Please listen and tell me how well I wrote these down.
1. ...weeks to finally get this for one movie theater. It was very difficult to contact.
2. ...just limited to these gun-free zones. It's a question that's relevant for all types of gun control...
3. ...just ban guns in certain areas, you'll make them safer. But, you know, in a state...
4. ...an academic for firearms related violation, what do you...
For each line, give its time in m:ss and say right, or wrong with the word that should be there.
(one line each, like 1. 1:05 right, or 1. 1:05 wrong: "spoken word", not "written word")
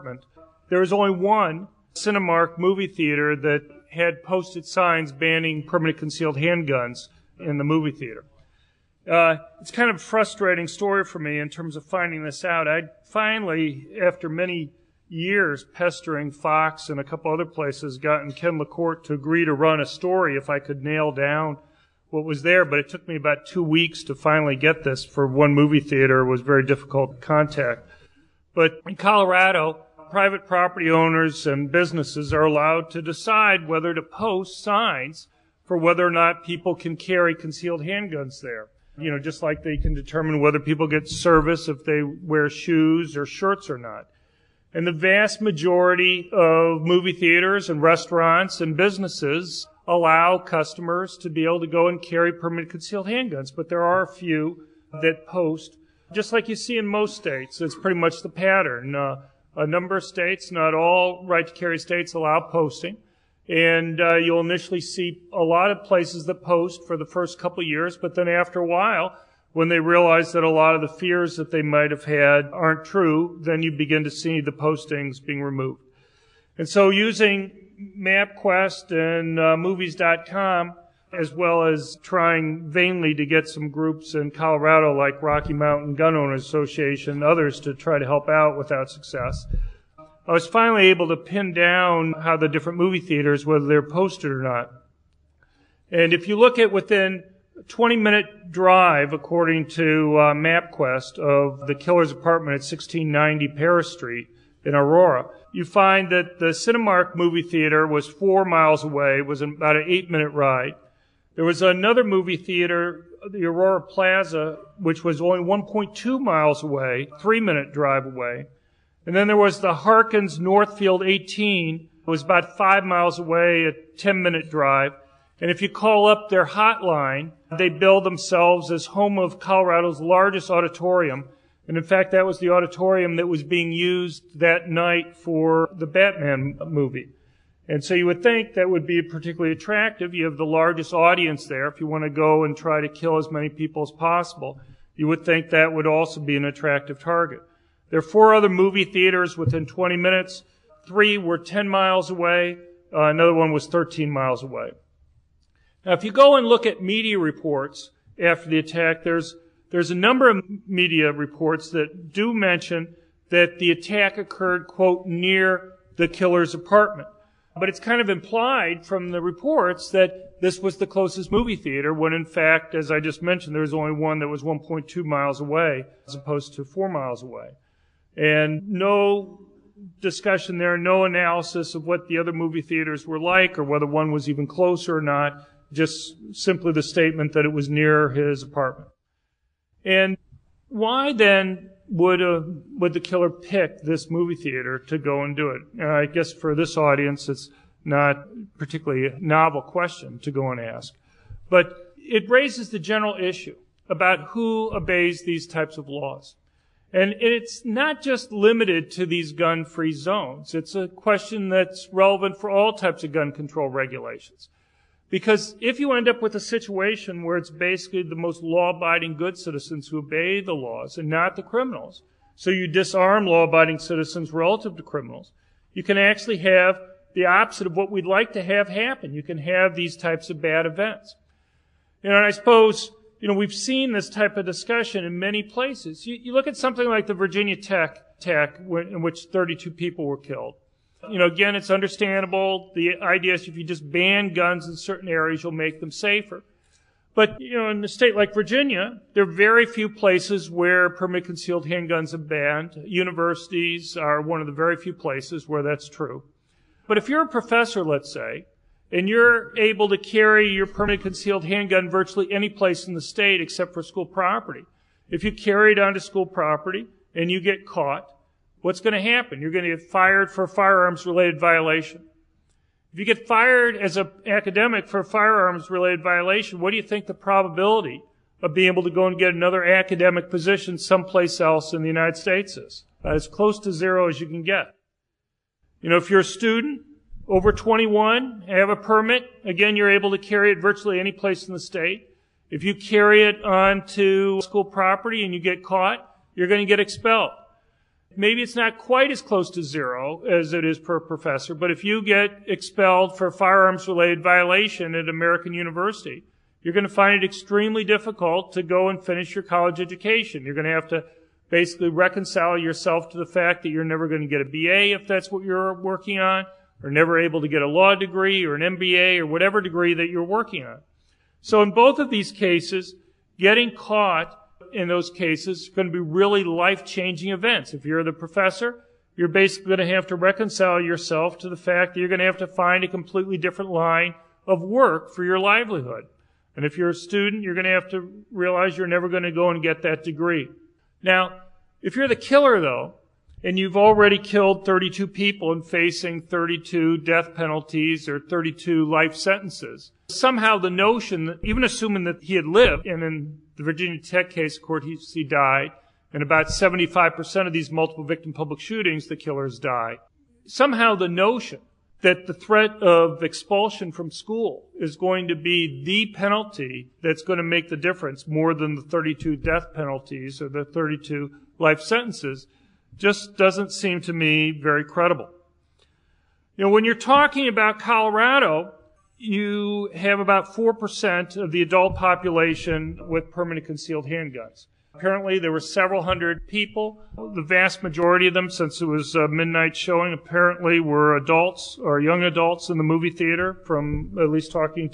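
1. 0:23 right
2. 3:28 right
3. 4:03 right
4. 4:33 right.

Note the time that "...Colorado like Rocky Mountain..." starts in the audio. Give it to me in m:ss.
1:24.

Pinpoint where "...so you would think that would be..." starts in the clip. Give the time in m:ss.
2:17.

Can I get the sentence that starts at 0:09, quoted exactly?
Uh, it's kind of a frustrating story for me in terms of finding this out.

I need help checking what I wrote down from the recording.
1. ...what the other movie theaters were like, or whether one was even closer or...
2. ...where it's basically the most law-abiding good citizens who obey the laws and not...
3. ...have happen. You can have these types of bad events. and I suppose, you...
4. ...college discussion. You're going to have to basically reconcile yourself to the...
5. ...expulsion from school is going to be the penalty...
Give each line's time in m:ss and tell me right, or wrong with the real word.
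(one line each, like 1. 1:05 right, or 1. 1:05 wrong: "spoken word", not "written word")
1. 3:01 right
2. 3:37 right
3. 3:48 right
4. 5:09 wrong: "education", not "discussion"
5. 6:03 right.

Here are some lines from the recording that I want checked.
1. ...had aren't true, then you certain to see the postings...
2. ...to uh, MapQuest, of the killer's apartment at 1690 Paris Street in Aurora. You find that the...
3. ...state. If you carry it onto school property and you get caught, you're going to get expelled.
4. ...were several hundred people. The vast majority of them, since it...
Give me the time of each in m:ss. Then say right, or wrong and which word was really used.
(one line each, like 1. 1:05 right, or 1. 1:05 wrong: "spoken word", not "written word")
1. 1:12 wrong: "begin", not "certain"
2. 1:39 right
3. 4:51 right
4. 6:25 right.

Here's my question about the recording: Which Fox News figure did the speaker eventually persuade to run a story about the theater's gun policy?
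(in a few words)
Ken LaCorte.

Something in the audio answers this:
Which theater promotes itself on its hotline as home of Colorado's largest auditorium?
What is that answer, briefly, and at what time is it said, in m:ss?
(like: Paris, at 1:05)
Harkins Northfield 18, at 1:59.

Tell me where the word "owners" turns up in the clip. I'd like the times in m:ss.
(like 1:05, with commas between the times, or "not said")
0:30, 1:26.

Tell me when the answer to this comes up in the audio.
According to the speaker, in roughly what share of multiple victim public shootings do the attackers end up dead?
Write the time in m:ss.
5:56.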